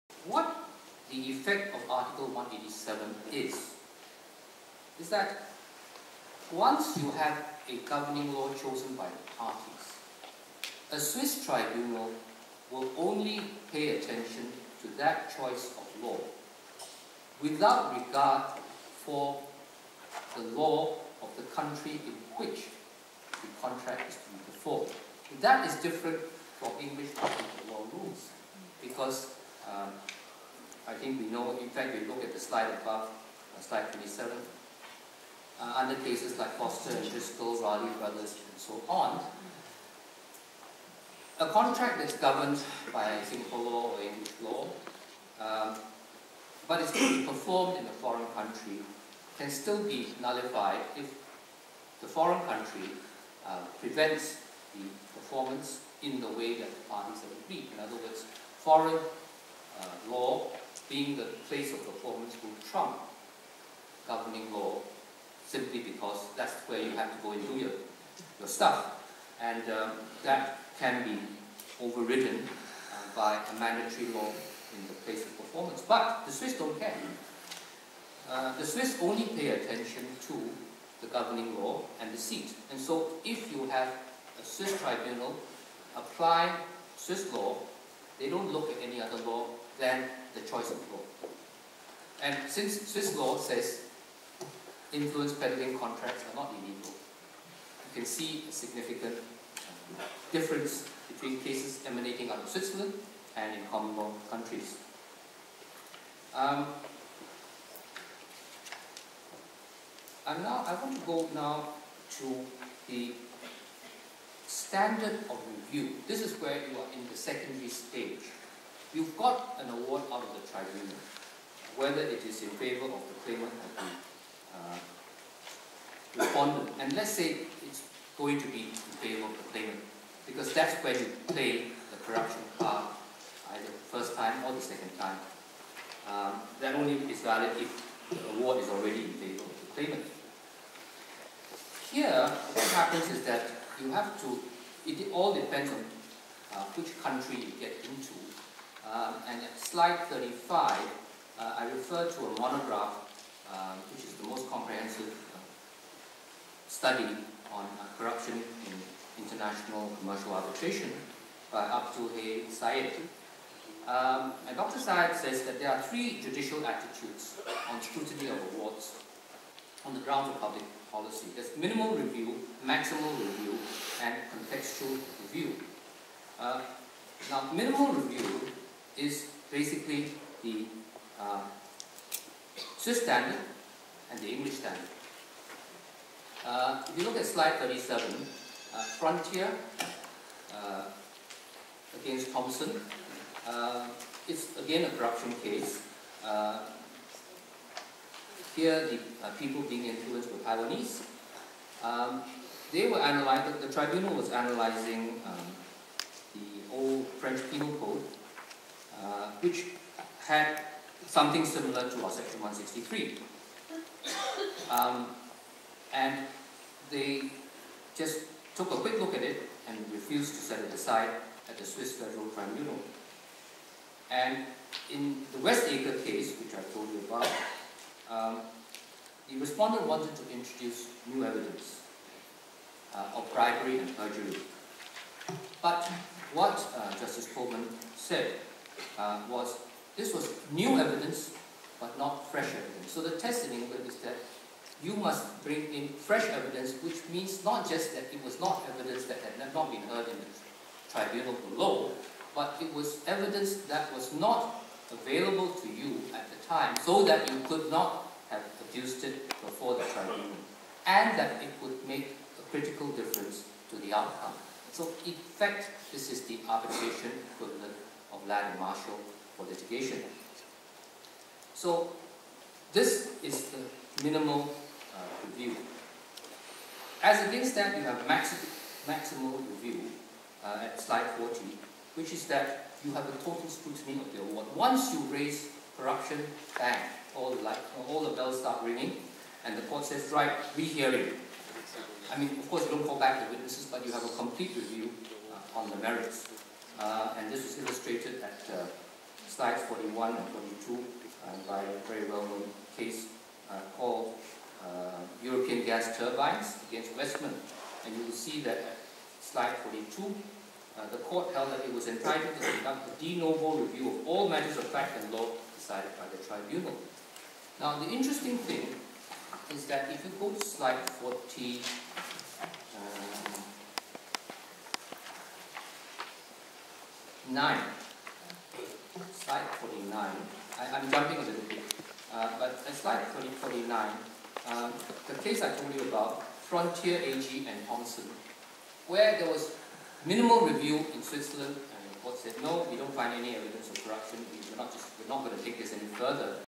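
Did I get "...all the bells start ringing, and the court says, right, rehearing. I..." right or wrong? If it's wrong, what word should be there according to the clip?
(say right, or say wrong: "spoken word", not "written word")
right.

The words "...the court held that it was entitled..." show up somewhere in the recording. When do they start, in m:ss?
5:10.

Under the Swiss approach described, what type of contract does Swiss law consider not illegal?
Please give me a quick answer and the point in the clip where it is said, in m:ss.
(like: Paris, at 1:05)
Influence peddling contracts, at 1:34.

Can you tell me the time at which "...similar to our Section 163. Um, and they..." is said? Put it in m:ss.
3:31.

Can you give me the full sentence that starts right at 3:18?
here, the people being influenced were Taiwanese.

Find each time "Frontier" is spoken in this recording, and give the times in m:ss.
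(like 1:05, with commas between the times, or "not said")
3:08, 5:36.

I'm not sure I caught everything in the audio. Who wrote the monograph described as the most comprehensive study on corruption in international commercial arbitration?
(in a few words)
Hay Sayed.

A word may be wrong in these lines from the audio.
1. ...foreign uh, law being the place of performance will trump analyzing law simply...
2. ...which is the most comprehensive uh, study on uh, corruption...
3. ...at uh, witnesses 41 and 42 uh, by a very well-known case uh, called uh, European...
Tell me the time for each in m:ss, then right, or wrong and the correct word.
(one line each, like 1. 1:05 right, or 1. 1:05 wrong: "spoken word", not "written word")
1. 0:58 wrong: "governing", not "analyzing"
2. 2:33 right
3. 4:58 wrong: "slides", not "witnesses".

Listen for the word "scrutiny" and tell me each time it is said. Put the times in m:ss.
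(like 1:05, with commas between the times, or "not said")
2:47, 4:43.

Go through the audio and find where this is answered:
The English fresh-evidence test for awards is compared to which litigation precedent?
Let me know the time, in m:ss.
4:28.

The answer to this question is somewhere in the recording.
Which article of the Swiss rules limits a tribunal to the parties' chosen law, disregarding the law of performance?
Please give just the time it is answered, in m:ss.
0:01.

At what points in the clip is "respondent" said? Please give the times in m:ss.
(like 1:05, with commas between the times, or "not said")
2:06, 3:49.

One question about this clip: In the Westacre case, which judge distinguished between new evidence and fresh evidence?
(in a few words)
Justice Colman.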